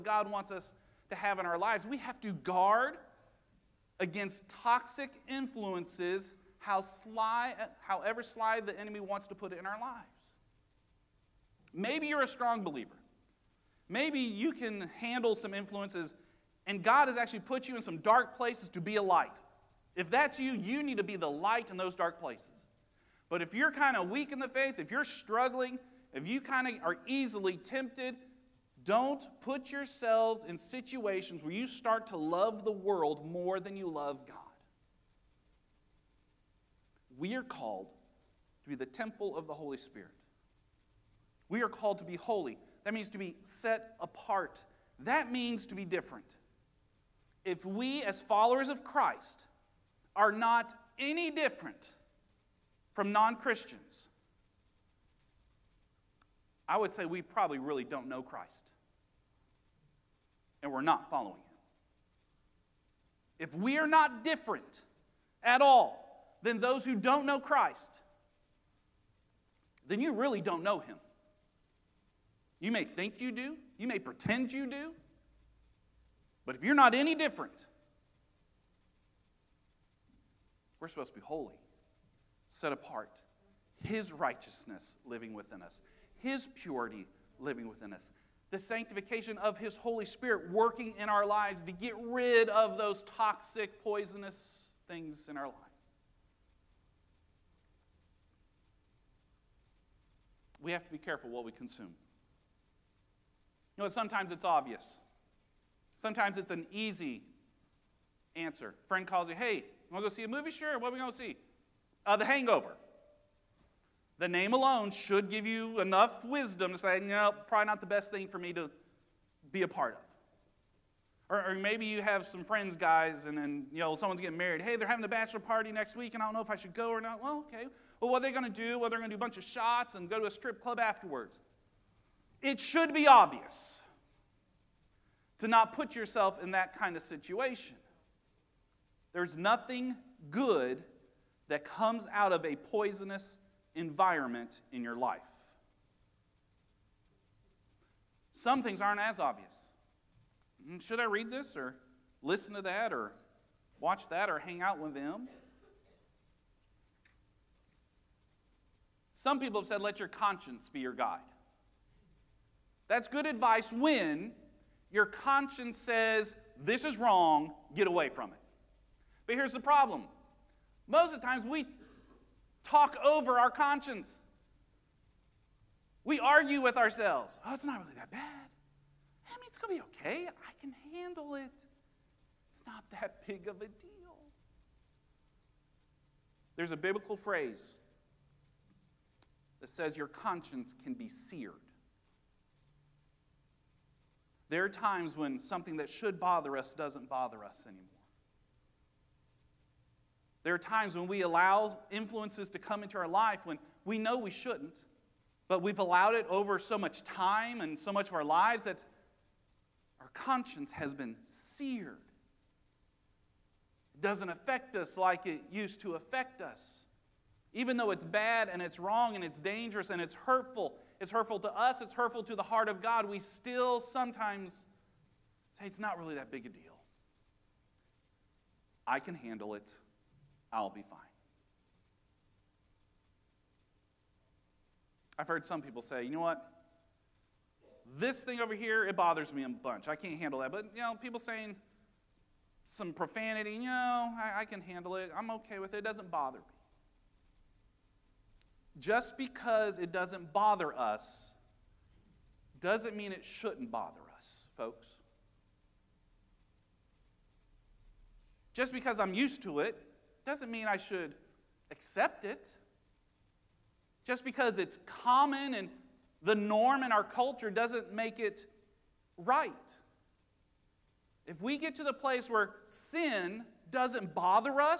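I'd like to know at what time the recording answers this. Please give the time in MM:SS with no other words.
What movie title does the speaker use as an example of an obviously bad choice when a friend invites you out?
01:52.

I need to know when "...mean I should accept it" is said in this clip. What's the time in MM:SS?
04:20.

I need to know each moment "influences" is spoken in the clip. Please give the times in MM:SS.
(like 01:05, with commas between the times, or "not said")
00:05, 00:15, 03:21.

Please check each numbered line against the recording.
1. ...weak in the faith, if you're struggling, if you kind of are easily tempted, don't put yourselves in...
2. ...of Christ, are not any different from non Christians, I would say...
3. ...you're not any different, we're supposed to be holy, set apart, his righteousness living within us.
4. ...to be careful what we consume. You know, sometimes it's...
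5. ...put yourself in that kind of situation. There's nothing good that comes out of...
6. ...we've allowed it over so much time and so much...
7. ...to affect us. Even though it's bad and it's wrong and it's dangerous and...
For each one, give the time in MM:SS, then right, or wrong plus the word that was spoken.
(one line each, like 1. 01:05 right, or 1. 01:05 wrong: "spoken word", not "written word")
1. 00:24 right
2. 00:48 right
3. 01:16 right
4. 01:40 right
5. 02:15 right
6. 03:25 right
7. 03:35 right.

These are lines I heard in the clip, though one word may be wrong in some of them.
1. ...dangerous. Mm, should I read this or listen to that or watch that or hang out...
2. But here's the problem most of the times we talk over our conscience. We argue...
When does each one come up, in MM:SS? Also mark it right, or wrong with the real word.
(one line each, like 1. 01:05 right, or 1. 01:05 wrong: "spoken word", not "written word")
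1. 02:29 wrong: "obvious", not "dangerous"
2. 02:49 right.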